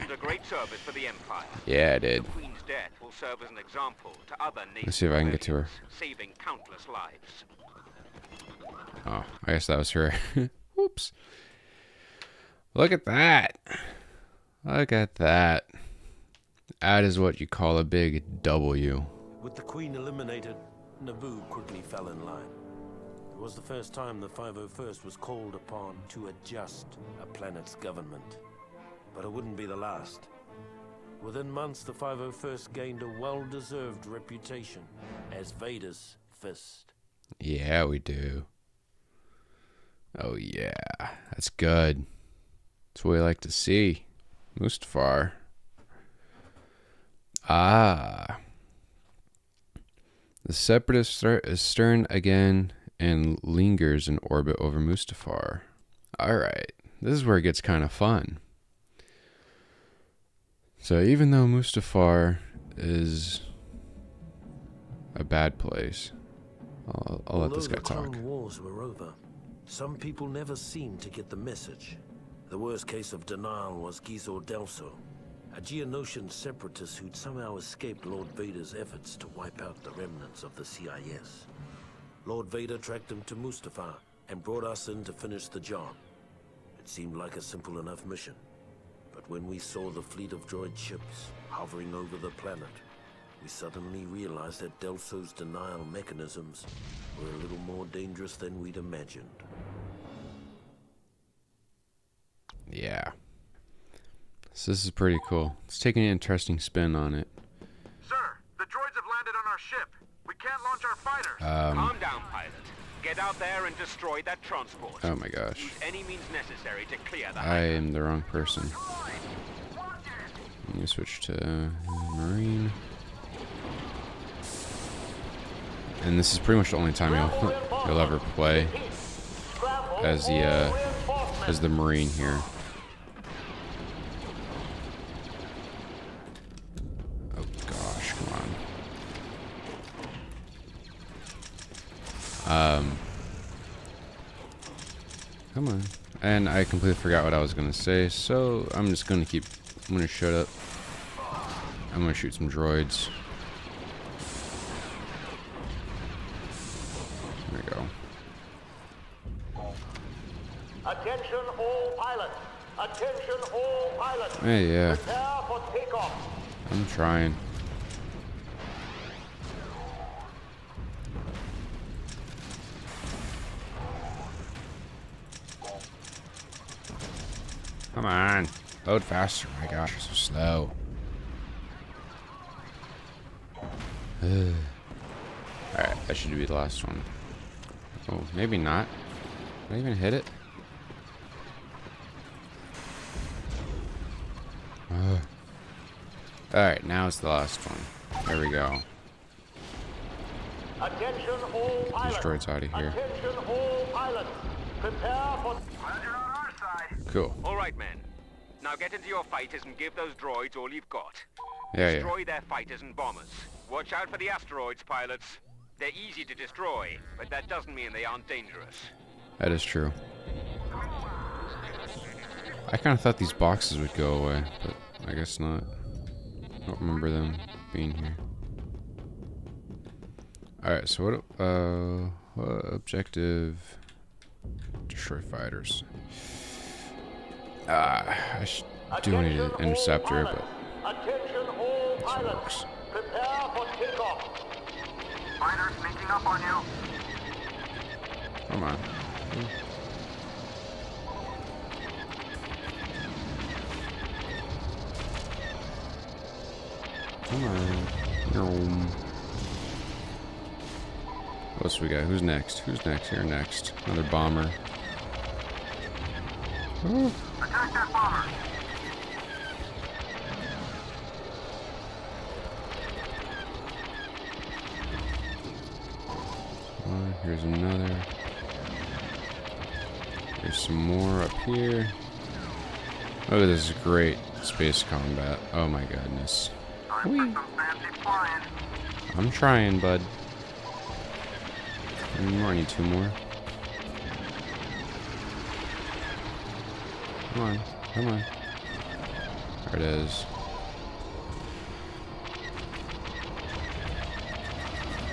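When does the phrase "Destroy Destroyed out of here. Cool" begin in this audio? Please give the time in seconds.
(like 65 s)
202 s.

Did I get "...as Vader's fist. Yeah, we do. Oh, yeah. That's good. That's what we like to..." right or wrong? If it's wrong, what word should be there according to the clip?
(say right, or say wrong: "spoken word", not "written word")
right.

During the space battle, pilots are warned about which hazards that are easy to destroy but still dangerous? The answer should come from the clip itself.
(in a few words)
asteroids.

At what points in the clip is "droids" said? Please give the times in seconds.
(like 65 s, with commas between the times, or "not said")
90 s, 108 s, 152 s, 210 s.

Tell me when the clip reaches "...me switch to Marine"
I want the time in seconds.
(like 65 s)
120 s.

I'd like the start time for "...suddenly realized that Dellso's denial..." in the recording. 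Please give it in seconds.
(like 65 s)
93 s.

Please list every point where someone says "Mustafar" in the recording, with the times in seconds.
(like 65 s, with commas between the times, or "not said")
44 s, 54 s, 61 s, 83 s.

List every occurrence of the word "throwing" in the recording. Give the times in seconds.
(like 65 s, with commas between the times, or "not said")
not said.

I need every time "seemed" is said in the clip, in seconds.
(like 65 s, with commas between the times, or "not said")
70 s, 86 s.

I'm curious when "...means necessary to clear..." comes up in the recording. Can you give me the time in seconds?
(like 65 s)
116 s.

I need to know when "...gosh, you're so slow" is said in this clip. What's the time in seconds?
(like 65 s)
179 s.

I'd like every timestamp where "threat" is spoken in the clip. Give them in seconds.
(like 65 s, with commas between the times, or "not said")
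51 s.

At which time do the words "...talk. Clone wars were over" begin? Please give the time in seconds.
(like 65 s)
67 s.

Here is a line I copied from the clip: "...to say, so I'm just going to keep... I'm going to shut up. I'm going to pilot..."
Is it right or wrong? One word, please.
wrong.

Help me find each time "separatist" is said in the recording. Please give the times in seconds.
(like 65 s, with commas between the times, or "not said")
50 s, 76 s.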